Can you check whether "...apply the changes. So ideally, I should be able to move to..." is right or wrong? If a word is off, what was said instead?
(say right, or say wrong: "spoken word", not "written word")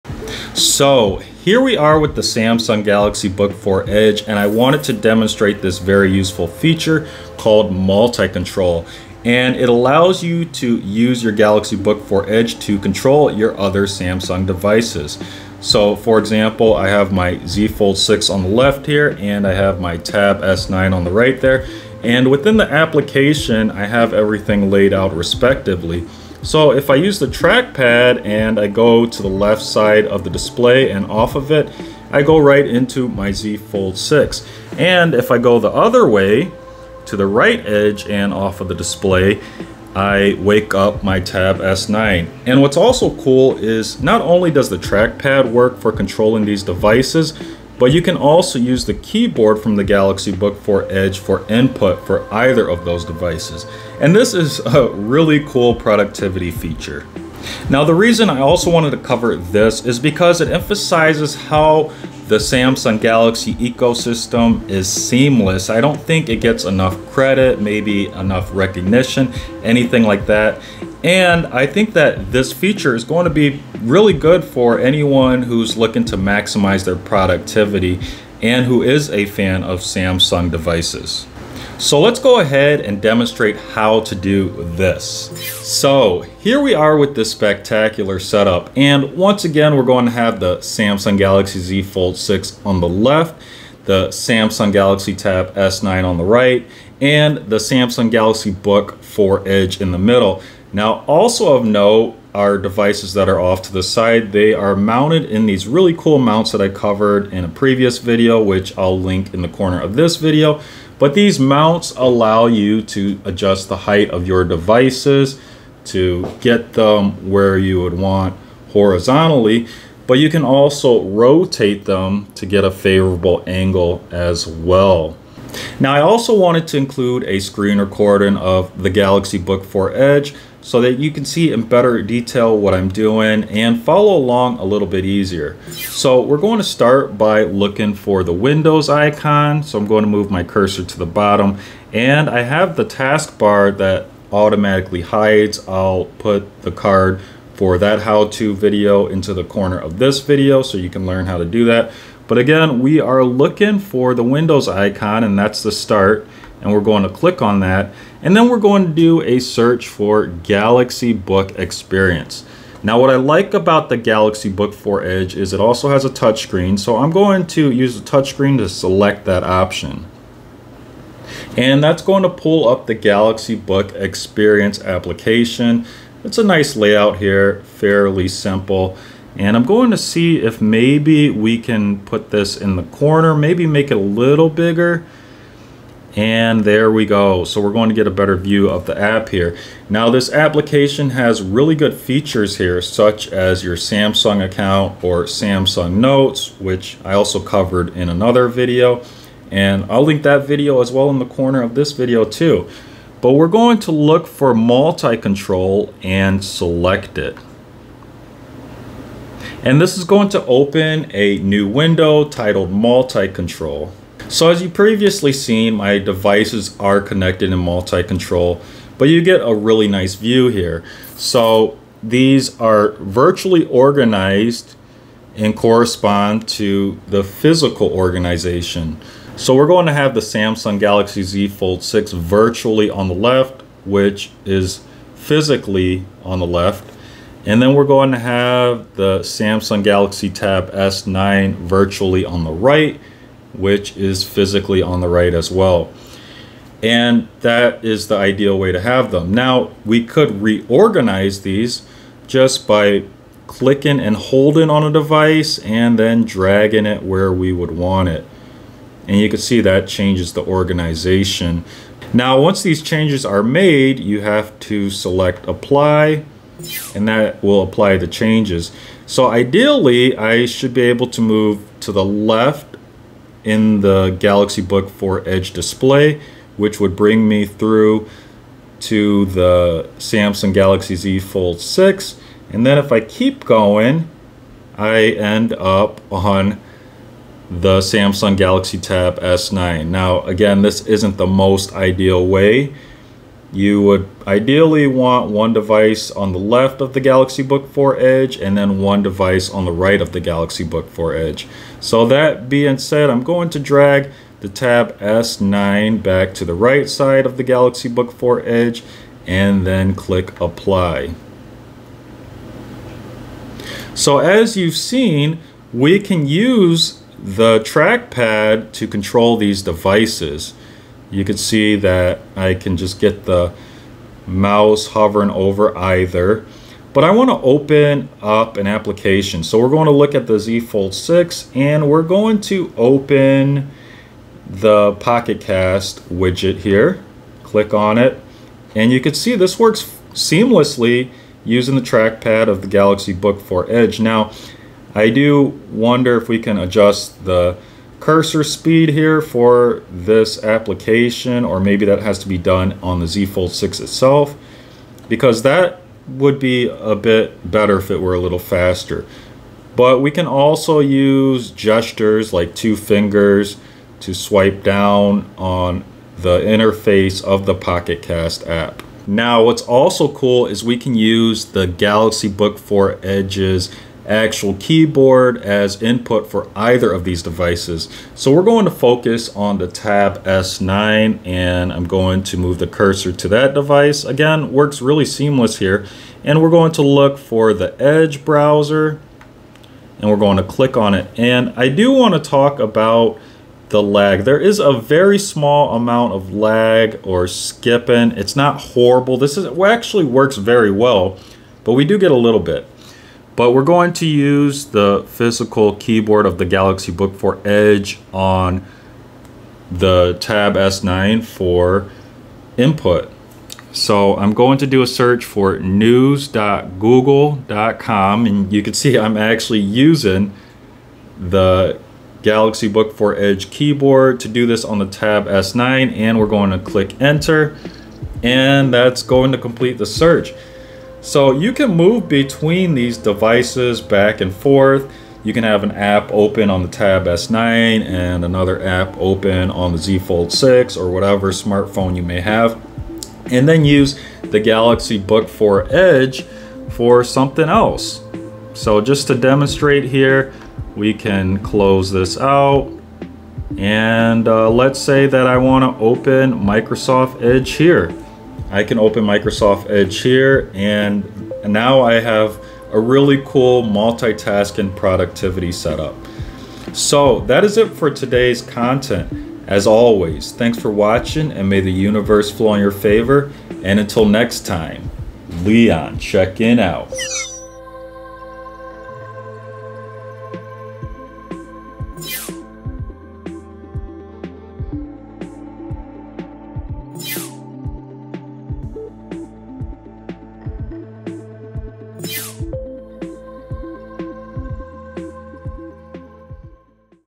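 right.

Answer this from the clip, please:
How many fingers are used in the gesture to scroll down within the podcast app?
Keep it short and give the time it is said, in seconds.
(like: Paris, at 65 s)
2, at 362 s.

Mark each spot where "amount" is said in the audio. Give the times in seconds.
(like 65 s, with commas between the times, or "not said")
395 s.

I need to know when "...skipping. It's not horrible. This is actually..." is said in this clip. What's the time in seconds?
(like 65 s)
397 s.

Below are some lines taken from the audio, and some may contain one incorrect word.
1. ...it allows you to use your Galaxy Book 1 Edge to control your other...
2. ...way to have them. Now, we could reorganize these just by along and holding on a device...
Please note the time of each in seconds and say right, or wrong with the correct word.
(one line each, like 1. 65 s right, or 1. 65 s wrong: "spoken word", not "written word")
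1. 9 s wrong: "4", not "1"
2. 248 s wrong: "clicking", not "along".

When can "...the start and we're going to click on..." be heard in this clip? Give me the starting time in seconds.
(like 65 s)
155 s.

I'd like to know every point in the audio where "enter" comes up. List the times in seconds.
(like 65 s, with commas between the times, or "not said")
427 s.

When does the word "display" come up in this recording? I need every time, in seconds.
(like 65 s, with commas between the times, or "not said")
30 s, 38 s, 275 s.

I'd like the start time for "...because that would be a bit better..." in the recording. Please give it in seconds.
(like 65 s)
355 s.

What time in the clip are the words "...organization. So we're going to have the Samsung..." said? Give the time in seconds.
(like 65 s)
227 s.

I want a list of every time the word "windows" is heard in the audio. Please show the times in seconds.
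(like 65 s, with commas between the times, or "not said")
138 s, 154 s, 211 s.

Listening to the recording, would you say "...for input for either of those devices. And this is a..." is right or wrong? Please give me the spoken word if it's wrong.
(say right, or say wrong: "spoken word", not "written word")
right.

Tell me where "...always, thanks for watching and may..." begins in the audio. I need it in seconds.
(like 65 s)
469 s.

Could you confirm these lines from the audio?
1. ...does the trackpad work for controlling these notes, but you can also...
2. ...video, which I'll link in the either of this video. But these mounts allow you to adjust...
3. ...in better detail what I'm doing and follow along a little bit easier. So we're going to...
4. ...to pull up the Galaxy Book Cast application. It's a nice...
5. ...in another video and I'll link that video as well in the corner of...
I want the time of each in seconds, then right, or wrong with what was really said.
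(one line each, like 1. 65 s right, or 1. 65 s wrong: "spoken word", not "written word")
1. 44 s wrong: "devices", not "notes"
2. 107 s wrong: "corner", not "either"
3. 131 s right
4. 172 s wrong: "Experience", not "Cast"
5. 197 s right.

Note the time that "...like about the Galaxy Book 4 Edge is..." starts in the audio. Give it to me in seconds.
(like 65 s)
163 s.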